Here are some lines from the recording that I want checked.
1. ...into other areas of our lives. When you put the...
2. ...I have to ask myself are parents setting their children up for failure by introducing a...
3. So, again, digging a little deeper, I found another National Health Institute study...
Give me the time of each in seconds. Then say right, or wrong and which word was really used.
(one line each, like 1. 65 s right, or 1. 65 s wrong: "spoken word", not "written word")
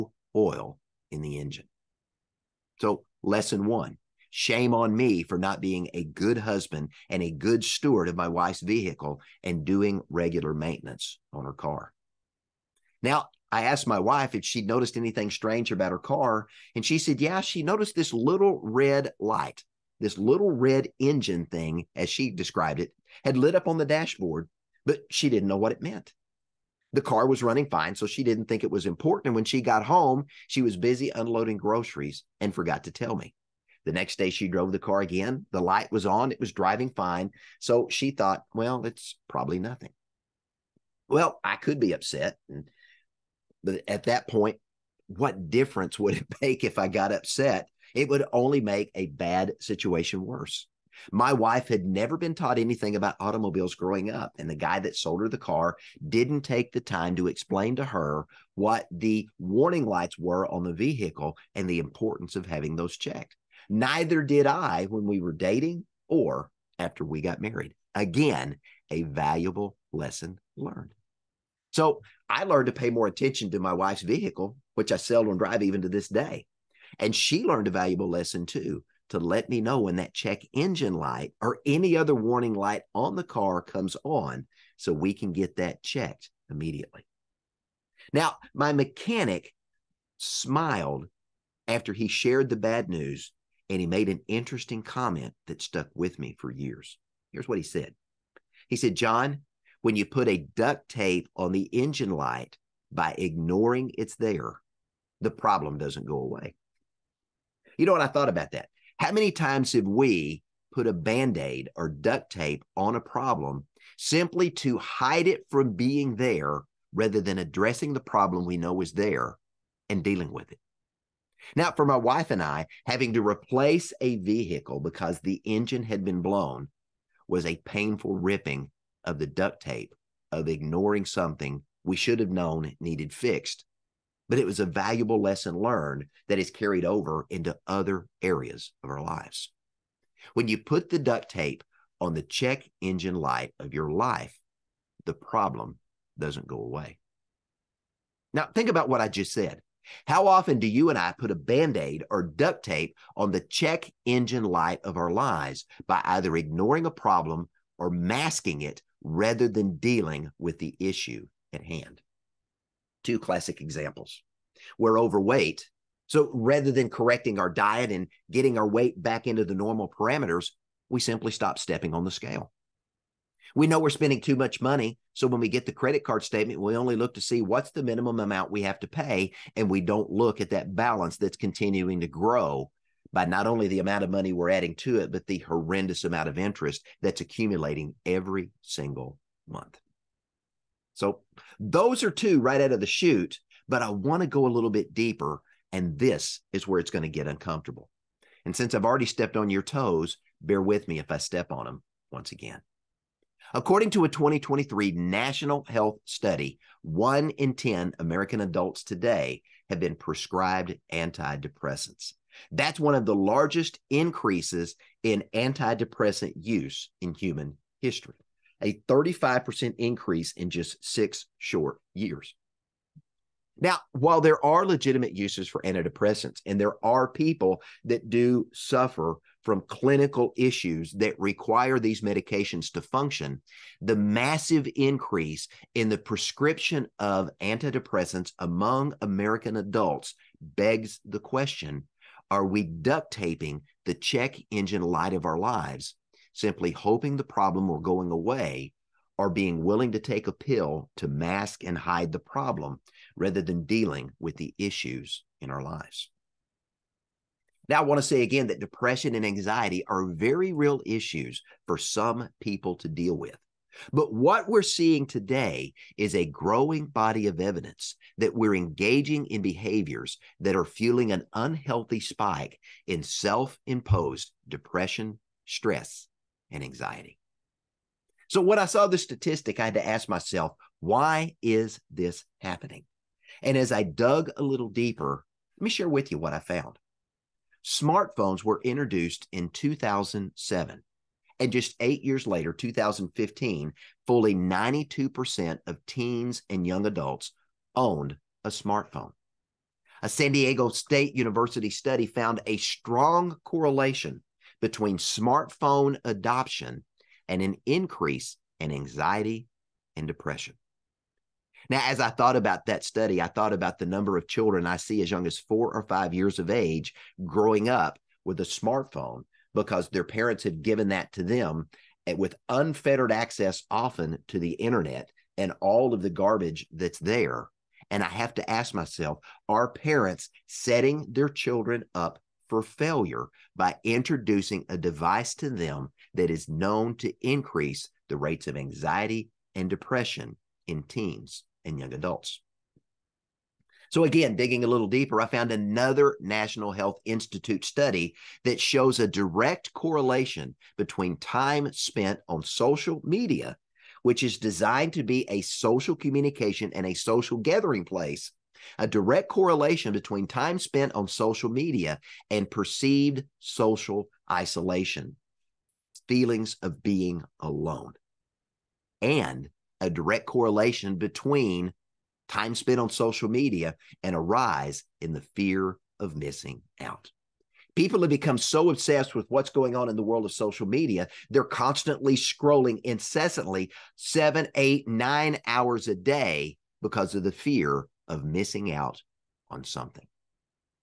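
1. 137 s right
2. 328 s right
3. 343 s right.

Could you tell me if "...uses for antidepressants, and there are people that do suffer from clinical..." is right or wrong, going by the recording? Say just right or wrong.
right.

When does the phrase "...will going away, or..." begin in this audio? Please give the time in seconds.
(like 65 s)
247 s.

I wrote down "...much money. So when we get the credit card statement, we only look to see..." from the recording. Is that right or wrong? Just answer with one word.
right.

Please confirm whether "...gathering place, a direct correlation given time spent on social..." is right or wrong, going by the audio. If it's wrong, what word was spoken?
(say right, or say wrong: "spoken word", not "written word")
wrong: "between", not "given".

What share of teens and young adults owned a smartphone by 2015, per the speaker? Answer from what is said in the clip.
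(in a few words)
92%.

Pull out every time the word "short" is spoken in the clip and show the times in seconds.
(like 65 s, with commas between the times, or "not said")
221 s.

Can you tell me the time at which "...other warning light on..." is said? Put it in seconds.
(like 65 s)
81 s.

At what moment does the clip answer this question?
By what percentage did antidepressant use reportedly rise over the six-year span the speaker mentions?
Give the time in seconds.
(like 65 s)
218 s.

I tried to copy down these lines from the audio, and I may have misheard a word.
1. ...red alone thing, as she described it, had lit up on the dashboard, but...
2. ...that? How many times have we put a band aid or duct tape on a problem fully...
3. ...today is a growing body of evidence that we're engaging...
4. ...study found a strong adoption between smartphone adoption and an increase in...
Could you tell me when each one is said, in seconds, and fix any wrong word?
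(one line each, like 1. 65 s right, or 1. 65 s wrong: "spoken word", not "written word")
1. 20 s wrong: "engine", not "alone"
2. 108 s wrong: "simply", not "fully"
3. 265 s right
4. 301 s wrong: "correlation", not "adoption".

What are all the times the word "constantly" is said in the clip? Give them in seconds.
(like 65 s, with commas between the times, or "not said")
381 s.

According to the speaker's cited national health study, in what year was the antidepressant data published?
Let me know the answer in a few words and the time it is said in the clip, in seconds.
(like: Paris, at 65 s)
2023, at 204 s.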